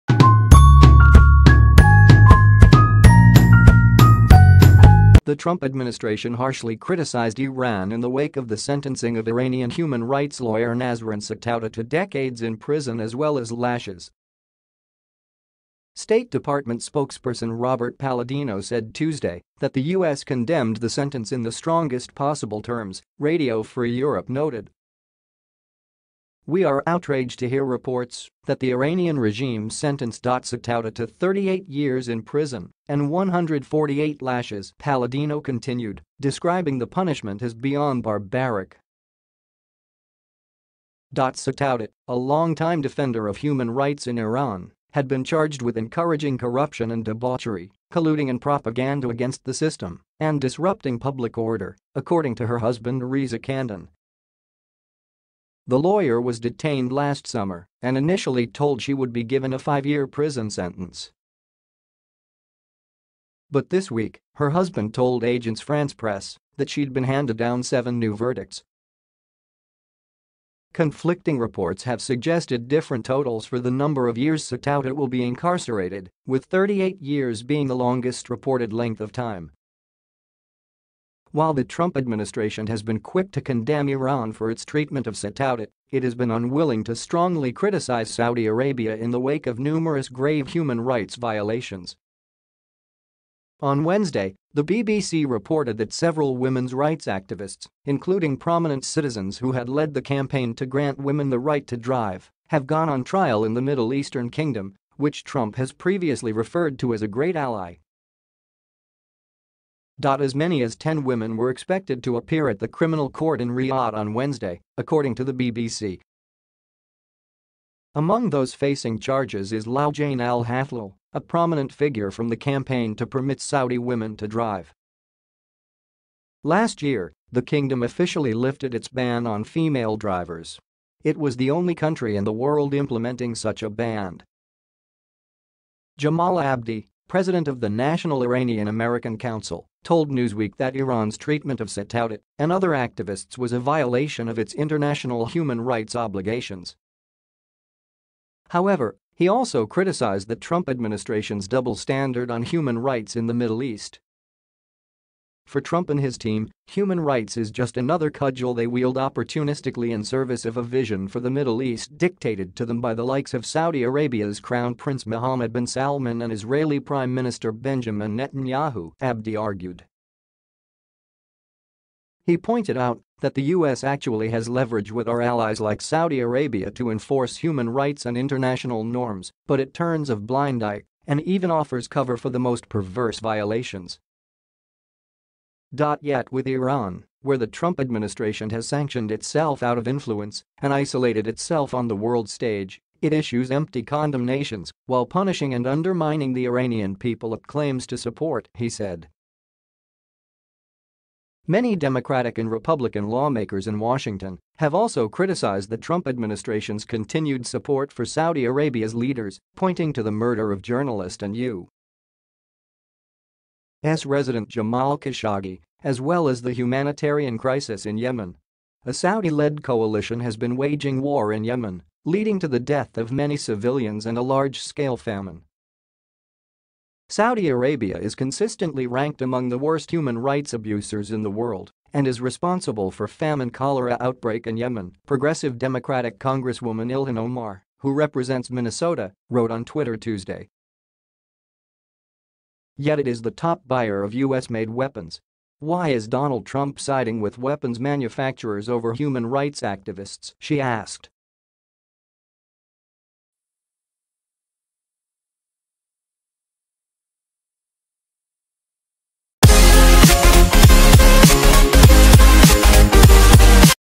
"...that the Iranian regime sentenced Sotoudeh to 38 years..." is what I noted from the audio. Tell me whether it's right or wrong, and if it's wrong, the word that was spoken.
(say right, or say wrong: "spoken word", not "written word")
right.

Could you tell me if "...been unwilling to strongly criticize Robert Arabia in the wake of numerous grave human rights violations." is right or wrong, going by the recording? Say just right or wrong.
wrong.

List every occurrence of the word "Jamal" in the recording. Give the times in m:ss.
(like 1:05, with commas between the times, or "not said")
2:15, 3:34.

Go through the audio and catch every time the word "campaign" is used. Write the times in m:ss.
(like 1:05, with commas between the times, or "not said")
1:40, 2:02.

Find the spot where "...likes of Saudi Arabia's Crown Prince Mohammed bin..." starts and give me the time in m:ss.
2:43.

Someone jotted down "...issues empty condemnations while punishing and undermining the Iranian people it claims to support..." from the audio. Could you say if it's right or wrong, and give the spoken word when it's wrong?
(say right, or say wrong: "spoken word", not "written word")
right.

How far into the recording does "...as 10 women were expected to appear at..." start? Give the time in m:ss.
1:50.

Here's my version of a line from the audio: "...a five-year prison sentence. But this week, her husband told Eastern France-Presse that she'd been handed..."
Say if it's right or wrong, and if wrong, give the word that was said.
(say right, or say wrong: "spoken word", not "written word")
wrong: "Agence", not "Eastern".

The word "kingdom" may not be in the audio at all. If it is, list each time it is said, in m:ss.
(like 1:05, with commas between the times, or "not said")
1:44, 2:07.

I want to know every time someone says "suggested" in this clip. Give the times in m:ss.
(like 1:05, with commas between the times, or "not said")
1:12.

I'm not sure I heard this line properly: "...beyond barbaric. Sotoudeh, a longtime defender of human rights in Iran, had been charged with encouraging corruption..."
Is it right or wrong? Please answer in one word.
right.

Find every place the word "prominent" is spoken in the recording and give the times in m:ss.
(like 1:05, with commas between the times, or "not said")
1:38, 2:01.